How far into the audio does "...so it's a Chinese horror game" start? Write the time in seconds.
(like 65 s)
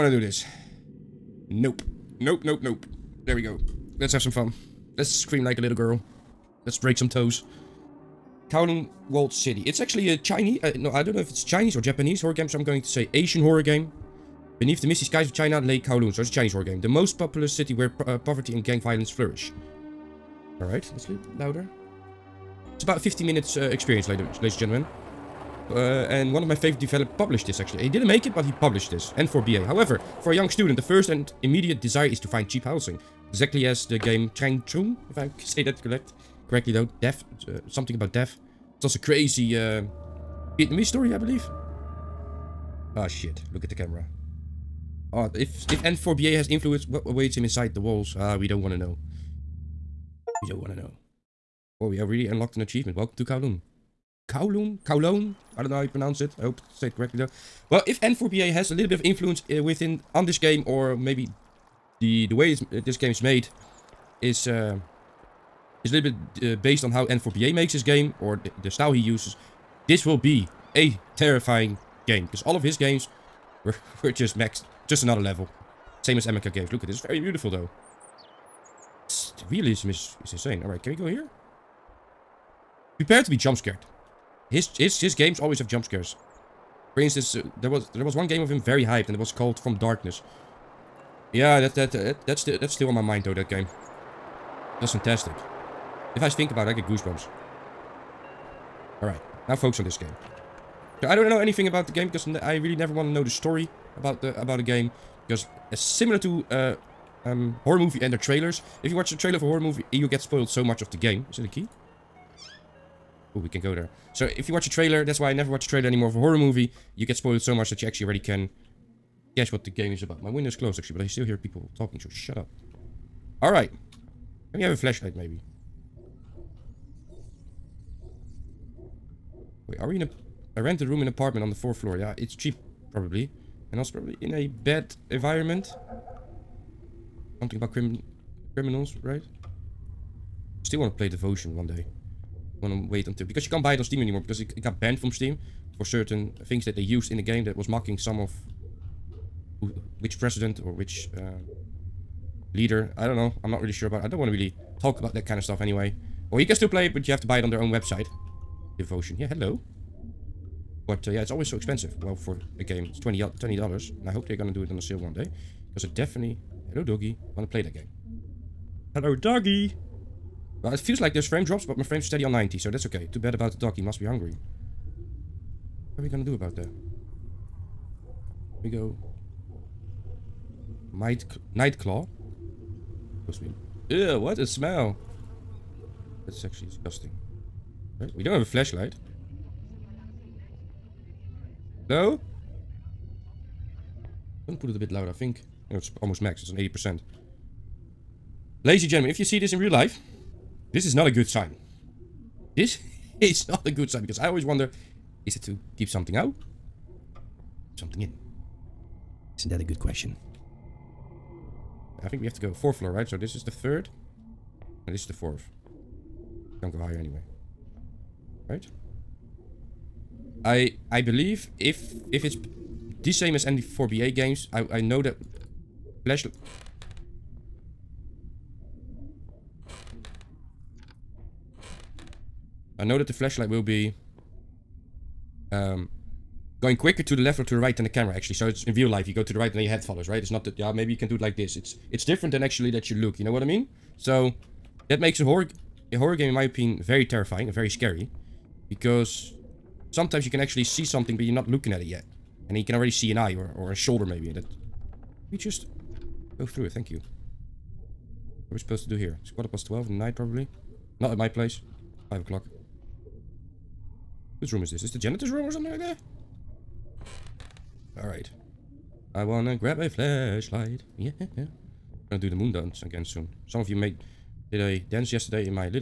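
16 s.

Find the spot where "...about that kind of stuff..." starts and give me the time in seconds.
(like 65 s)
154 s.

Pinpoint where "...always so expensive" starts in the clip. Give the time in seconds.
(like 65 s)
161 s.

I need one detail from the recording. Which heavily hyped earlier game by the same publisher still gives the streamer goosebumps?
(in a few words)
From Darkness.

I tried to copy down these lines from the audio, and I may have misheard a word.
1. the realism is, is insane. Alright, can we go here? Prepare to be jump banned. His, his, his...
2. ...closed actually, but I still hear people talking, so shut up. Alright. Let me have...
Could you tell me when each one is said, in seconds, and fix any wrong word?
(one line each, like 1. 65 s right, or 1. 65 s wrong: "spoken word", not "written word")
1. 79 s wrong: "scared", not "banned"
2. 120 s right.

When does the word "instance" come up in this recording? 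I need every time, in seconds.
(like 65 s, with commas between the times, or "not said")
86 s.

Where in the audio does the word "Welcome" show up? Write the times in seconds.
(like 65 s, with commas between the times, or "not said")
52 s.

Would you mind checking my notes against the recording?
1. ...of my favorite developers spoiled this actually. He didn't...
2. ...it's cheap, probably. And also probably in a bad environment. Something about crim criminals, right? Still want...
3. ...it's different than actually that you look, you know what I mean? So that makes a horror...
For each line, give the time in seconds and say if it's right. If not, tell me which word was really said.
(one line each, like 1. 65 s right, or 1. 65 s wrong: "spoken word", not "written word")
1. 26 s wrong: "published", not "spoiled"
2. 132 s right
3. 241 s right.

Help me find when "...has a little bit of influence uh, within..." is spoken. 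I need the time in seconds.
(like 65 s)
58 s.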